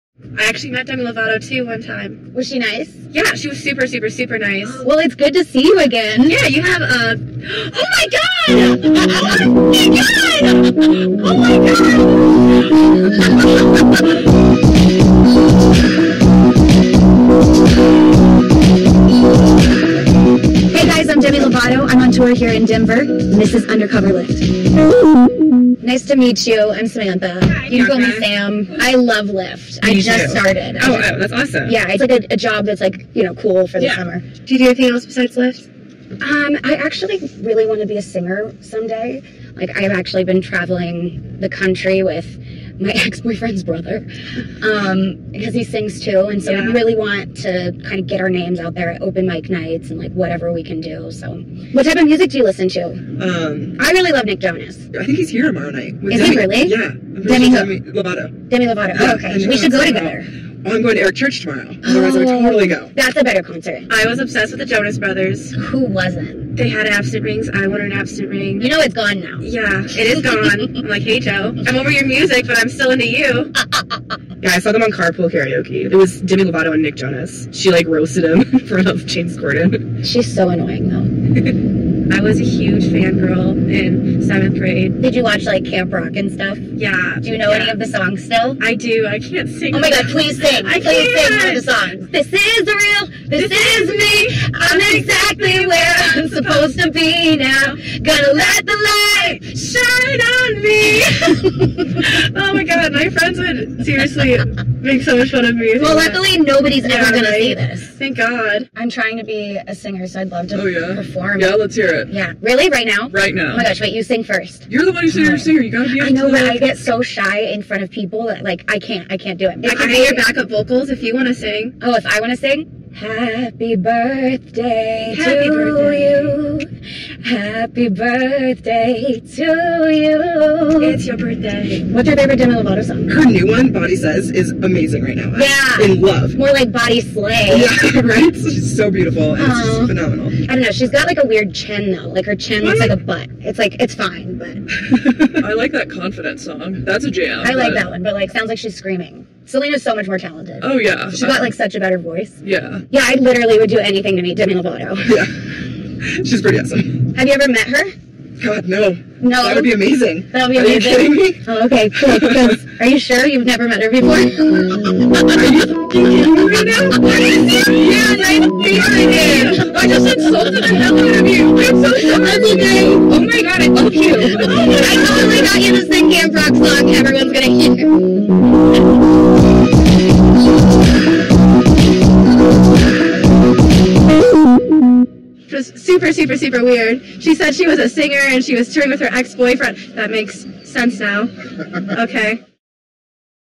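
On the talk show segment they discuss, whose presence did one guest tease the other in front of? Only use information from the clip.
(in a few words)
James Corden.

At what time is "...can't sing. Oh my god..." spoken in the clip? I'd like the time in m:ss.
1:29.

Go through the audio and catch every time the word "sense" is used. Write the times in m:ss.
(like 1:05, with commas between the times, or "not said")
3:10.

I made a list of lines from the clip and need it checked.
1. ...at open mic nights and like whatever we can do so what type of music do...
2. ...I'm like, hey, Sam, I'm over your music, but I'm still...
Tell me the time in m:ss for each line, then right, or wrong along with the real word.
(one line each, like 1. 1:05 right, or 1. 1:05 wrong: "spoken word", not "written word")
1. 0:48 right
2. 1:10 wrong: "Joe", not "Sam".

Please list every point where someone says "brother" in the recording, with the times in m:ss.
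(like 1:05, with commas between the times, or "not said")
0:43, 1:04.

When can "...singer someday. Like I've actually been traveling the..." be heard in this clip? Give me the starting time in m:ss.
0:38.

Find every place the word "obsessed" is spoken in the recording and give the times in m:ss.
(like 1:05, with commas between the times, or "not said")
1:04.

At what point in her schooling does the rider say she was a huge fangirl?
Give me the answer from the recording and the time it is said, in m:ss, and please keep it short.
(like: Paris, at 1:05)
seventh grade, at 1:24.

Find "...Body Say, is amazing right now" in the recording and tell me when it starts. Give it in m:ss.
2:13.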